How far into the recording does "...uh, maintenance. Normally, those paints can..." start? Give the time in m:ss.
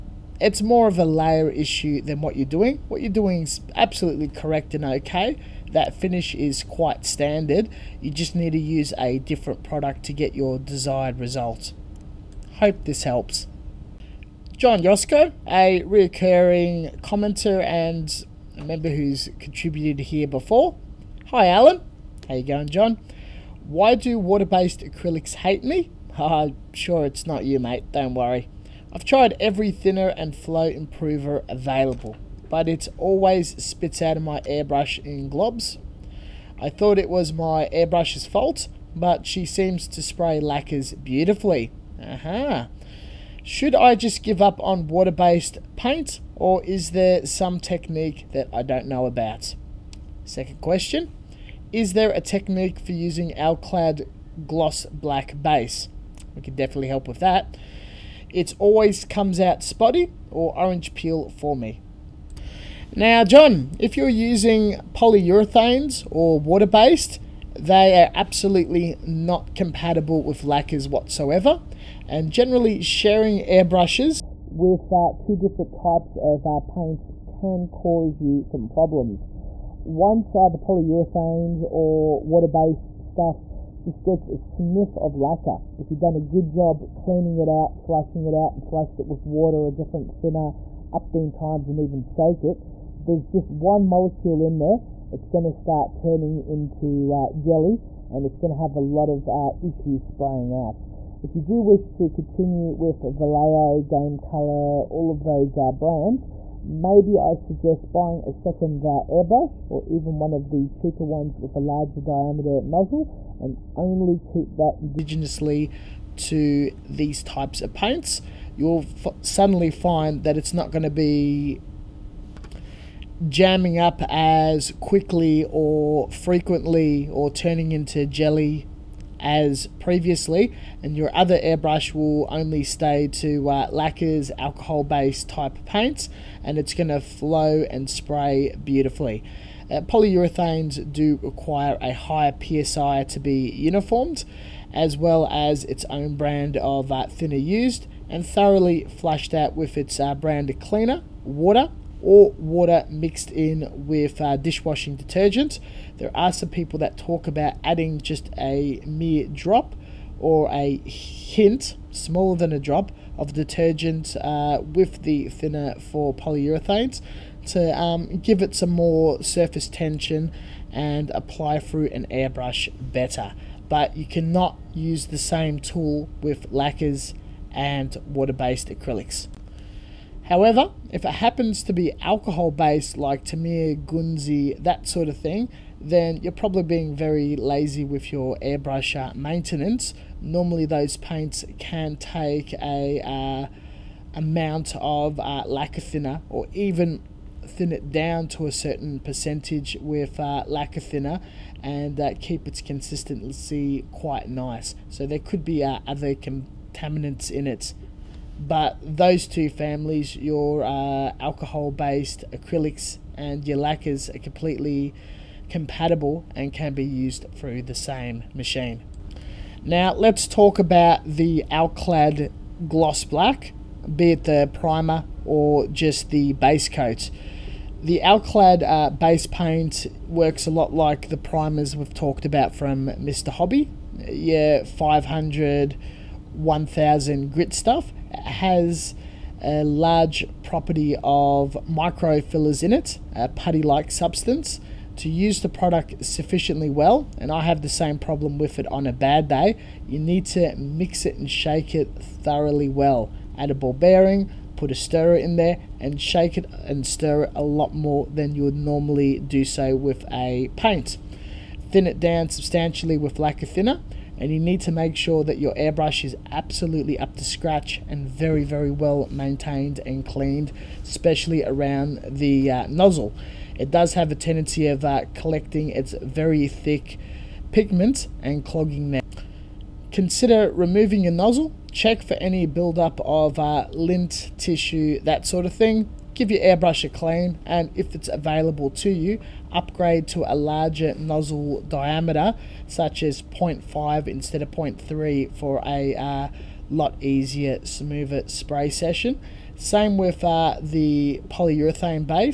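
3:09.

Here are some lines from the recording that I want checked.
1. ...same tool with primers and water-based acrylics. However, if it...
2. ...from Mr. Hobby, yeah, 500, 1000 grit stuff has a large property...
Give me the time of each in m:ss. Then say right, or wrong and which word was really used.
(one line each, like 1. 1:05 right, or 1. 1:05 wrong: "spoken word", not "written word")
1. 2:55 wrong: "lacquers", not "primers"
2. 3:52 right.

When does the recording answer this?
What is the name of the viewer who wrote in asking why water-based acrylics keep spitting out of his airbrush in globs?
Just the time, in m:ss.
0:14.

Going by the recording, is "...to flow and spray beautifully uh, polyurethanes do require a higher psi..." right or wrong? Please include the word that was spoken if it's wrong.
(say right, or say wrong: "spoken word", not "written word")
right.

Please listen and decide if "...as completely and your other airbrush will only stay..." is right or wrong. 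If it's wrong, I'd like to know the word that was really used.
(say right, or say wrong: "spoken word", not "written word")
wrong: "previously", not "completely".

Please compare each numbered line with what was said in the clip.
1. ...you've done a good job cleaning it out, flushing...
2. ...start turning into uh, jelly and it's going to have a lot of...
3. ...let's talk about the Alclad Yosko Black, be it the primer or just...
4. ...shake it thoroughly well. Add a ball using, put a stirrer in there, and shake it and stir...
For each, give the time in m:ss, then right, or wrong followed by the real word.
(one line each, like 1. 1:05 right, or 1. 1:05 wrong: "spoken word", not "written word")
1. 1:25 right
2. 1:35 right
3. 3:39 wrong: "Gloss", not "Yosko"
4. 4:11 wrong: "bearing", not "using".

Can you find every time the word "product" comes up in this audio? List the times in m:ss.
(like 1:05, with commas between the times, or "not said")
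0:09, 4:05.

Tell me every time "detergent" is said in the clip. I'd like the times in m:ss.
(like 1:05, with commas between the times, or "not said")
2:34, 2:43.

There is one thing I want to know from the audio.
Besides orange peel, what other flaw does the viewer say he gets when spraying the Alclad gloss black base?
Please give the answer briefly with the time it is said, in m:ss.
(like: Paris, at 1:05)
spotty, at 0:59.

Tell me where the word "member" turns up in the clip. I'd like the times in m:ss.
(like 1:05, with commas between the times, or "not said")
0:18.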